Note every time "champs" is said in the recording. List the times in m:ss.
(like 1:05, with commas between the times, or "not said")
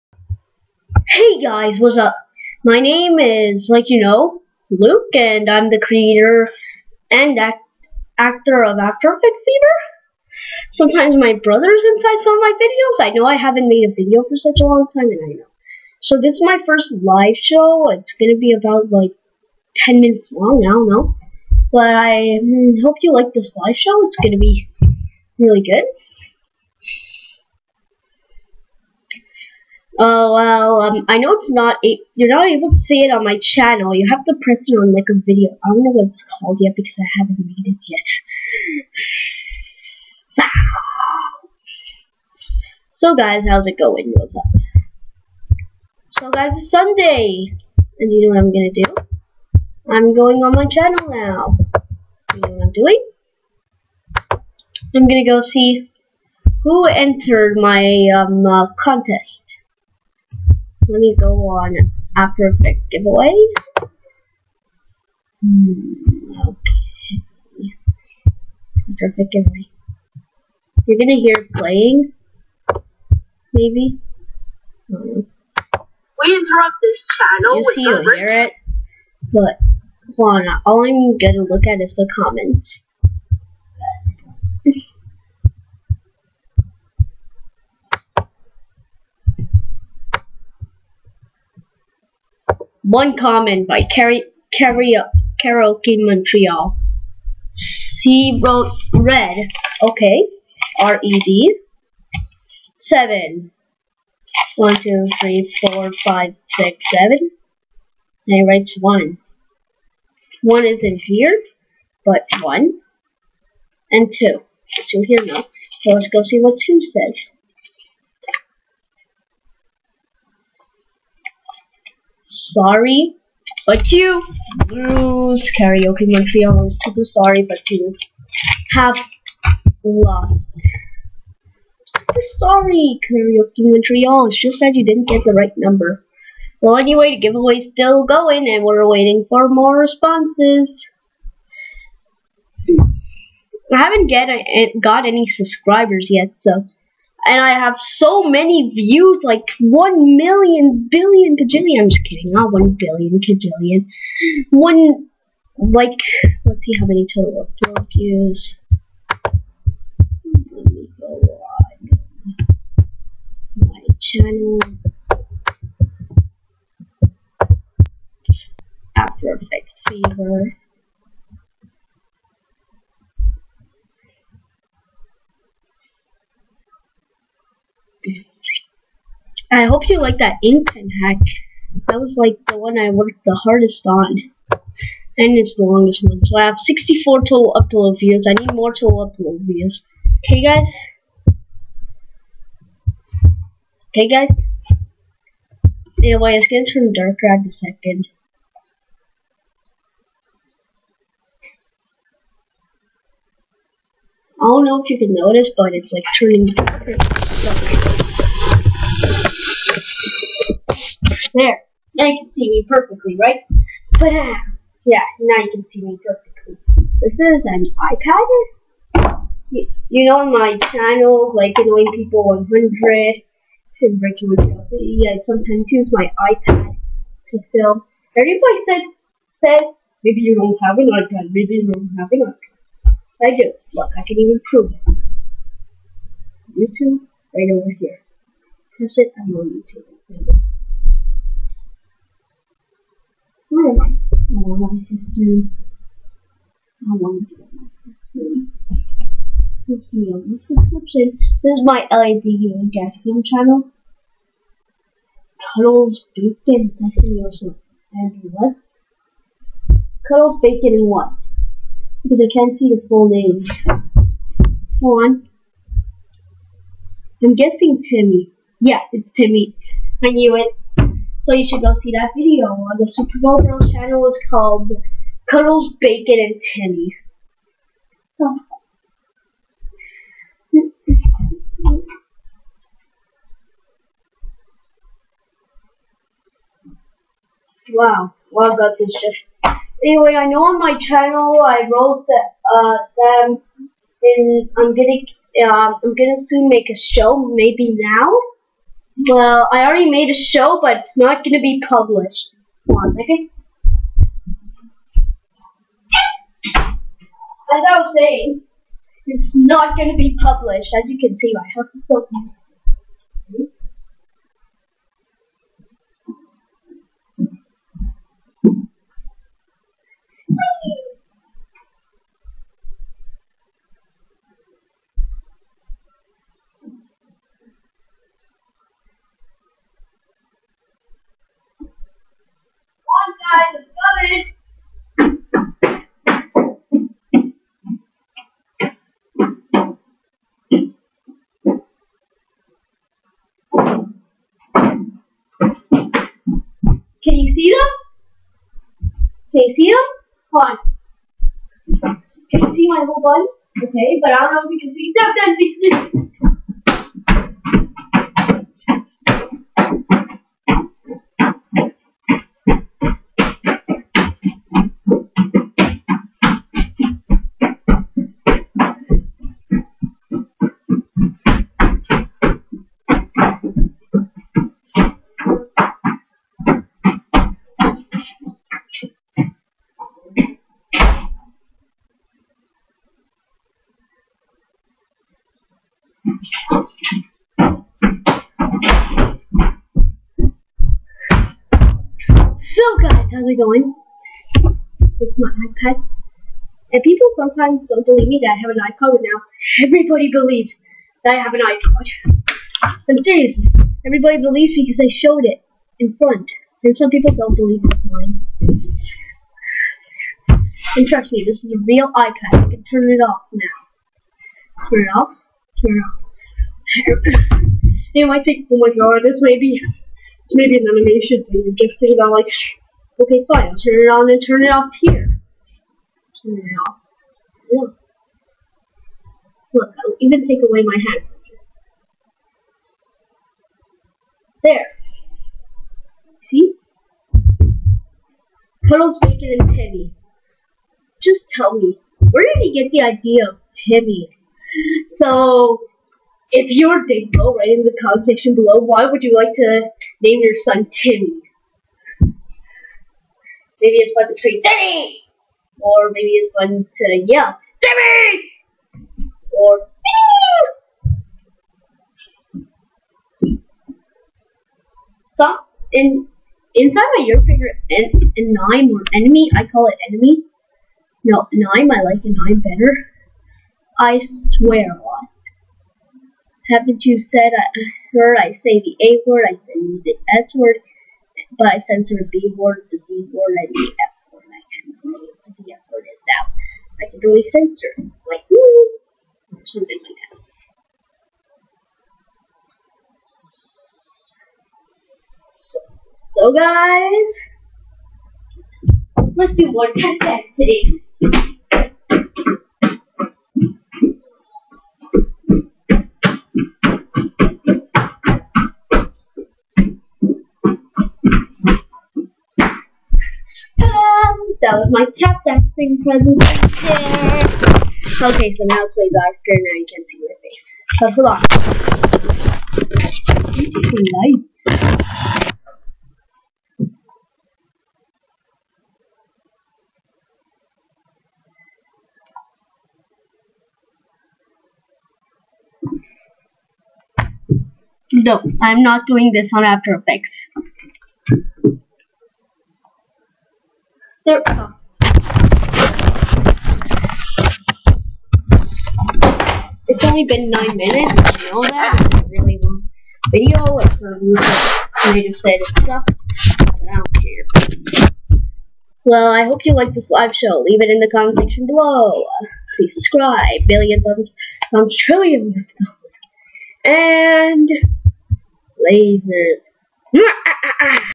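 not said.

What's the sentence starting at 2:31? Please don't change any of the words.
I'm just kidding, not one billion kajillion.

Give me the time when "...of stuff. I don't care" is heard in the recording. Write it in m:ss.
9:15.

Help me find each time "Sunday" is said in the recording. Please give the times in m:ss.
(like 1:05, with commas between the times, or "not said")
0:46.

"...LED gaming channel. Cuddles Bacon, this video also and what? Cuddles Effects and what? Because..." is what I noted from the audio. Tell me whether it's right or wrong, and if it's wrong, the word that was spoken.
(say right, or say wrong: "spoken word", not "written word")
wrong: "Bacon", not "Effects".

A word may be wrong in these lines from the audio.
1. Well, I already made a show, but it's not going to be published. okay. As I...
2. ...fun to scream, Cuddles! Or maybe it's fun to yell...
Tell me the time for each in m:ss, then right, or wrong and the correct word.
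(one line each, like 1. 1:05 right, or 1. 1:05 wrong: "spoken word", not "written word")
1. 4:59 right
2. 7:33 wrong: "Timmy", not "Cuddles".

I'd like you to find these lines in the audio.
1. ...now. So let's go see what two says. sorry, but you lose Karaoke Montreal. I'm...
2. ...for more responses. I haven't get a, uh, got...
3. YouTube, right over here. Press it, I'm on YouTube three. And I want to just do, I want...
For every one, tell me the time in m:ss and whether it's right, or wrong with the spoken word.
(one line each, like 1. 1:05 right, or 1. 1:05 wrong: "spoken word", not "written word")
1. 1:55 right
2. 2:19 right
3. 3:56 right.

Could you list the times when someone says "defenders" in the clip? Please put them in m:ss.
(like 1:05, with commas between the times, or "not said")
not said.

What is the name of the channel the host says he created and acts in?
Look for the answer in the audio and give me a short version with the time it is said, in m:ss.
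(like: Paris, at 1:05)
After Effects Fever, at 0:08.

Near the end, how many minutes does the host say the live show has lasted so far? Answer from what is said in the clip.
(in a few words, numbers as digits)
9.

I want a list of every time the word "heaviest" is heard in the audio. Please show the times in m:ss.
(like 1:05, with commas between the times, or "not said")
not said.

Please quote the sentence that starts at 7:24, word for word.
So, if you're Dingo, write in the comment section below, why would you like to name your son Timmy?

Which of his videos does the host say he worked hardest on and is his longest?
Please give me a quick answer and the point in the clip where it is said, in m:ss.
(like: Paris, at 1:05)
Ink pen hack, at 3:00.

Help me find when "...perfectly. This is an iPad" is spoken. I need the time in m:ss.
3:36.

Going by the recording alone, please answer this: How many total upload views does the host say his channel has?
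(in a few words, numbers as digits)
64.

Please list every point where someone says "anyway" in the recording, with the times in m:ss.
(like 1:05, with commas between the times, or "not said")
2:16, 3:16, 4:49.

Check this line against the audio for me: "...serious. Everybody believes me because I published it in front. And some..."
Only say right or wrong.
wrong.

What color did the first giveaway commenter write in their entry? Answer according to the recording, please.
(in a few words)
Red.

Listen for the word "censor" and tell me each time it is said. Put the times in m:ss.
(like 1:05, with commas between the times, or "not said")
8:01, 8:07.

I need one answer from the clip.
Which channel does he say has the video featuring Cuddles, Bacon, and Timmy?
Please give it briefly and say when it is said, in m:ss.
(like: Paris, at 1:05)
Super Bowl Girls, at 4:32.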